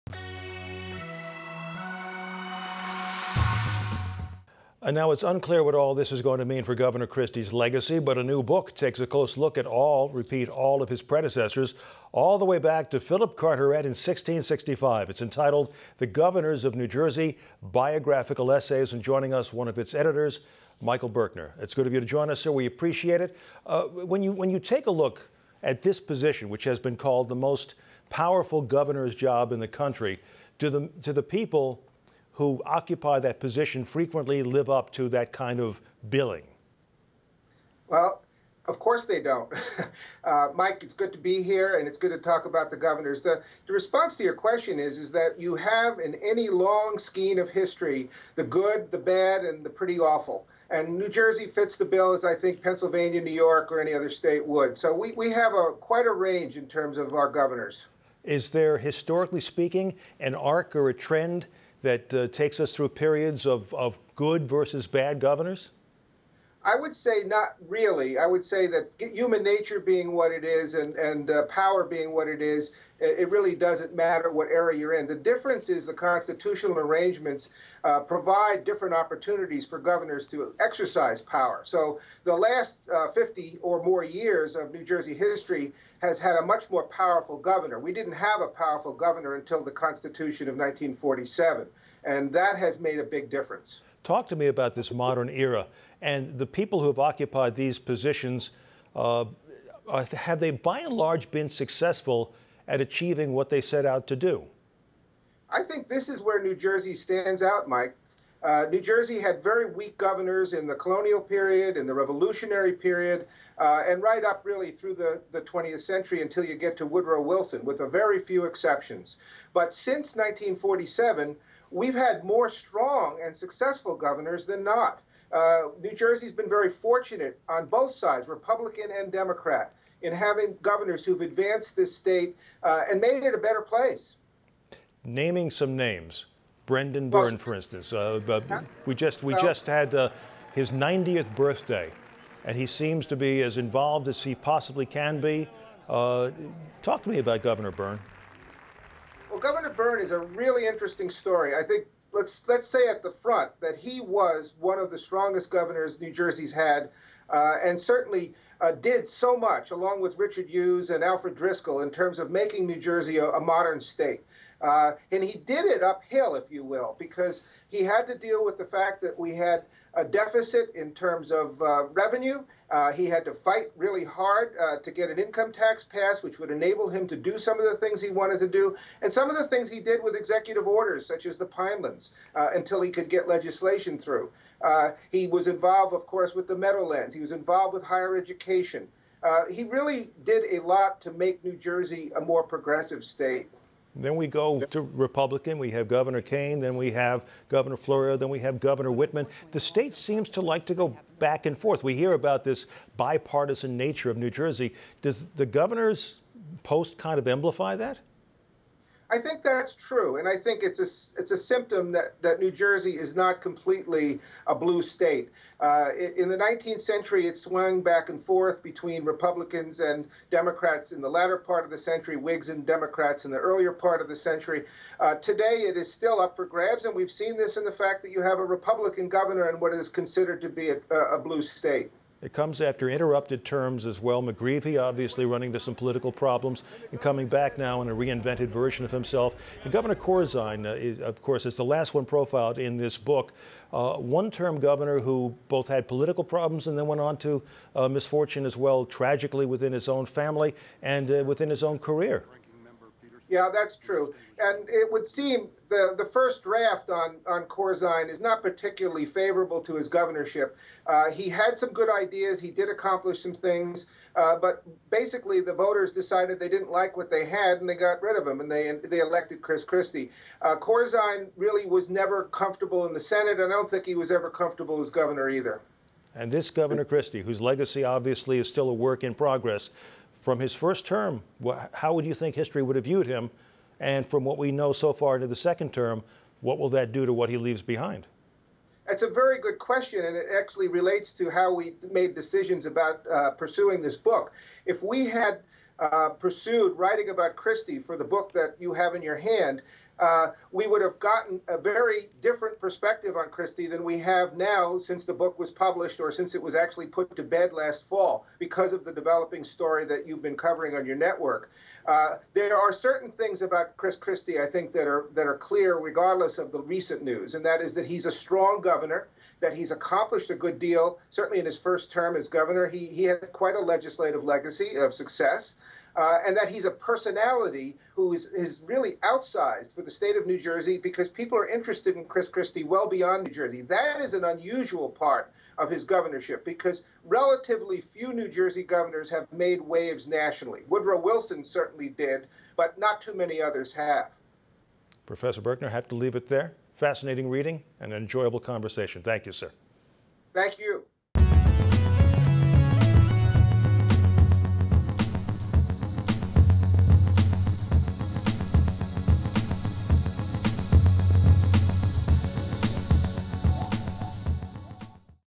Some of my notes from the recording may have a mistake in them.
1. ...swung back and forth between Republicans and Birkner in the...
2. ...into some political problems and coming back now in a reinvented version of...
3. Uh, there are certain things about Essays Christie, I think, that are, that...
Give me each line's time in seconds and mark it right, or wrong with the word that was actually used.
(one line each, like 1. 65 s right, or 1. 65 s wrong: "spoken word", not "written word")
1. 217 s wrong: "Democrats", not "Birkner"
2. 235 s right
3. 311 s wrong: "Chris", not "Essays".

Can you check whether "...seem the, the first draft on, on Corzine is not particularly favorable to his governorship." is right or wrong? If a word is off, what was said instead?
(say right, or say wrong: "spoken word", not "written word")
right.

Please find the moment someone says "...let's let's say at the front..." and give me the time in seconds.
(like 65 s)
152 s.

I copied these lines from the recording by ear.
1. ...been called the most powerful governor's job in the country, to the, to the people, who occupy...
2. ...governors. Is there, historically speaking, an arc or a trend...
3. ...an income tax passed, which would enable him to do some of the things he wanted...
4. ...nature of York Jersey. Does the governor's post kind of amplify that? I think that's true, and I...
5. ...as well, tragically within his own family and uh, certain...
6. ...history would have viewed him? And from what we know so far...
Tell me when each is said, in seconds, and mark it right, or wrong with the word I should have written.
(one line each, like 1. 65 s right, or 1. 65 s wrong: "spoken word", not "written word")
1. 26 s right
2. 57 s right
3. 175 s right
4. 203 s wrong: "New", not "York"
5. 248 s wrong: "within", not "certain"
6. 282 s right.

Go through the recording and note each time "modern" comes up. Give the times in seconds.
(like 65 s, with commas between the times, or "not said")
94 s, 163 s.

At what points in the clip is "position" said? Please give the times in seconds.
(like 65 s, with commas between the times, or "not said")
25 s, 33 s, 97 s.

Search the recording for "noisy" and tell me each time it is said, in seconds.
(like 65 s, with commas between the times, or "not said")
not said.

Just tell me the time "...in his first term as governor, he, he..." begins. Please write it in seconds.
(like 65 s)
321 s.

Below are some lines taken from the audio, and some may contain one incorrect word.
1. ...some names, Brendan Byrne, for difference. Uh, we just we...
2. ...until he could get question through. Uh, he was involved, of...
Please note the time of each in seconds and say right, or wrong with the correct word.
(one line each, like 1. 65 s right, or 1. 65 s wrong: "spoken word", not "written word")
1. 135 s wrong: "instance", not "difference"
2. 182 s wrong: "legislation", not "question".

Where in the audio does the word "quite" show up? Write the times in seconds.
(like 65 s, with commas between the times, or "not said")
55 s, 323 s.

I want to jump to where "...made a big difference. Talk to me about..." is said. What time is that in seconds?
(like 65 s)
92 s.